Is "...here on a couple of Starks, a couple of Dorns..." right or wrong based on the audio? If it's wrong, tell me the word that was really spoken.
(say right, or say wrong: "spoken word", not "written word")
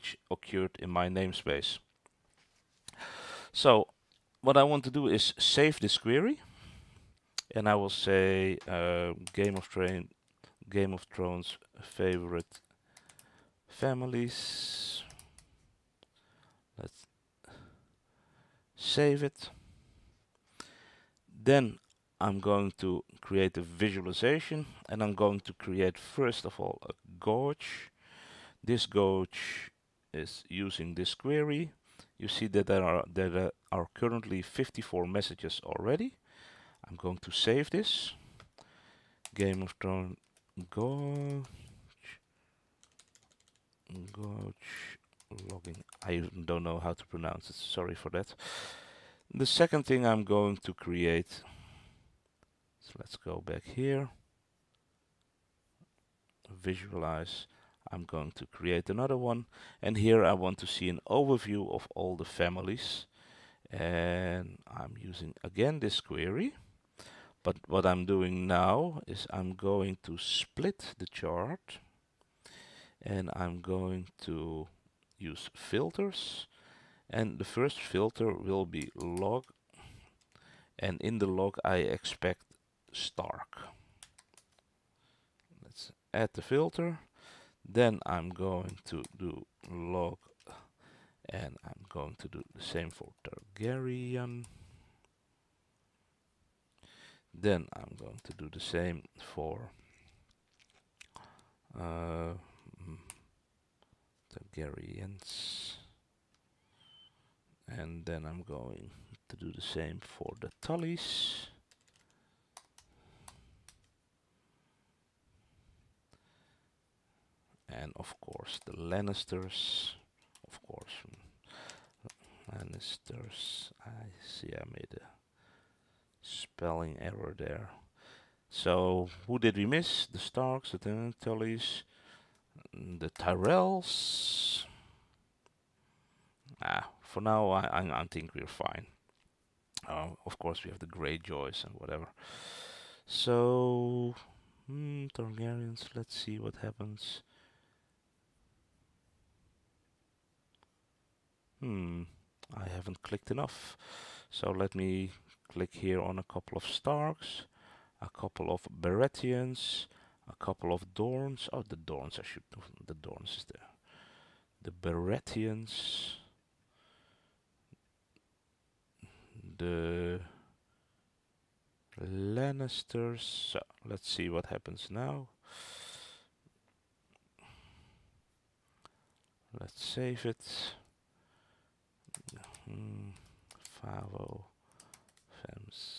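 wrong: "Baratheons", not "Dorns".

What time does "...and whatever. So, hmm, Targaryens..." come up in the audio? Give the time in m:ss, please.
2:21.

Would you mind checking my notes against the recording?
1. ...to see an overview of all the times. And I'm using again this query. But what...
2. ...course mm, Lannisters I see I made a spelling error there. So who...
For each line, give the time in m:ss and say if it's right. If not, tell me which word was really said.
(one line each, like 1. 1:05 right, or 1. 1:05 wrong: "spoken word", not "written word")
1. 1:00 wrong: "families", not "times"
2. 2:00 right.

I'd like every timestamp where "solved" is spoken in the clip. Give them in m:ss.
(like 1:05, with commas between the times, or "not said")
not said.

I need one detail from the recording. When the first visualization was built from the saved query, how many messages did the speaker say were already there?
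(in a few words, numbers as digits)
54.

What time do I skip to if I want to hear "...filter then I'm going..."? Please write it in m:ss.
1:26.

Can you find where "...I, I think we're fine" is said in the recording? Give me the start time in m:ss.
2:17.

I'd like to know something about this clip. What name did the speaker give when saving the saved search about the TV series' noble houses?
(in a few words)
Game of Thrones favorite families.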